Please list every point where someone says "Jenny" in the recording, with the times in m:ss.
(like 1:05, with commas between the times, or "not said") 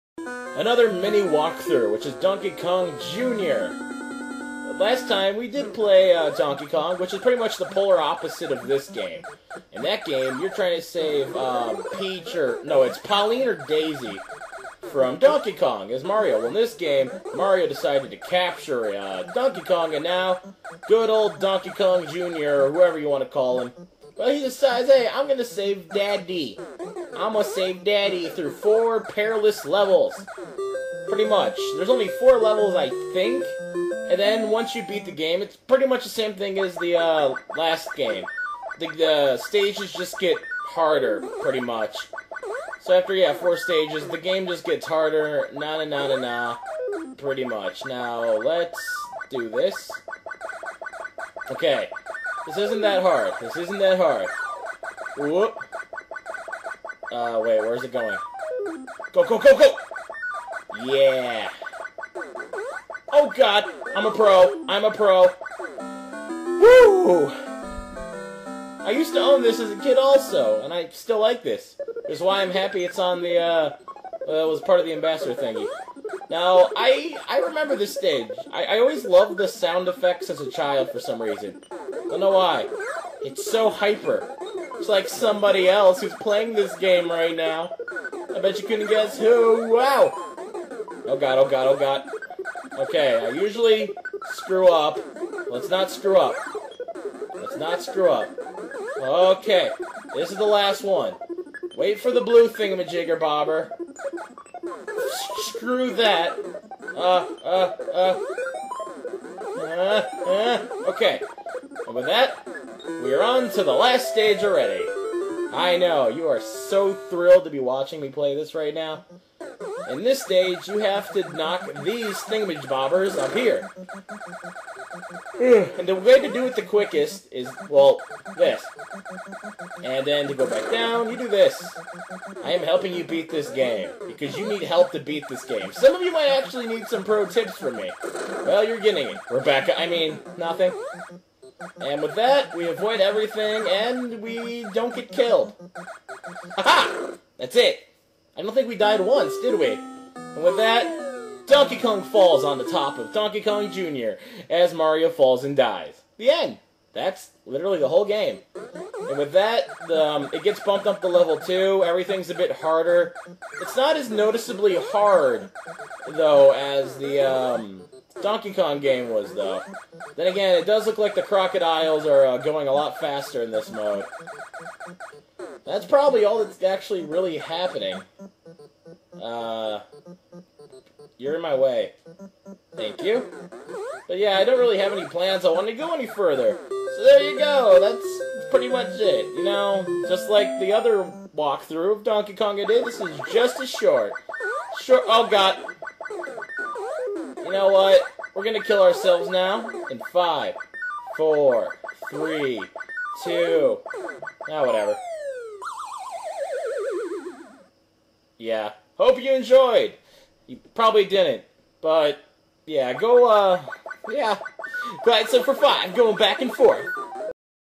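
not said.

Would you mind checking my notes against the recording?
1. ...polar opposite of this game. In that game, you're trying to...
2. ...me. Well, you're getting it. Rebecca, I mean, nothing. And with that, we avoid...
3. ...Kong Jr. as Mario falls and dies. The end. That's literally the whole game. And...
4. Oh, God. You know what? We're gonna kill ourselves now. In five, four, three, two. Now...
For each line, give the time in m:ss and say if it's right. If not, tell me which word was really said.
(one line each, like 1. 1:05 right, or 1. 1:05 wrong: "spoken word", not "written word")
1. 0:07 right
2. 2:17 right
3. 2:33 right
4. 3:15 right.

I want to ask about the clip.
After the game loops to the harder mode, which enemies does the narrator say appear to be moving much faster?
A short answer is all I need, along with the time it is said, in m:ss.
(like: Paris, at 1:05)
crocodiles, at 2:51.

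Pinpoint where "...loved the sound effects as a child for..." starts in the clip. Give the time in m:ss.
1:19.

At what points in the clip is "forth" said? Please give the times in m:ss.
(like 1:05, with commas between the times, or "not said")
3:36.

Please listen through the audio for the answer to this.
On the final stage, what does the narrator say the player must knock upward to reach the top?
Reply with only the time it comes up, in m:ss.
2:02.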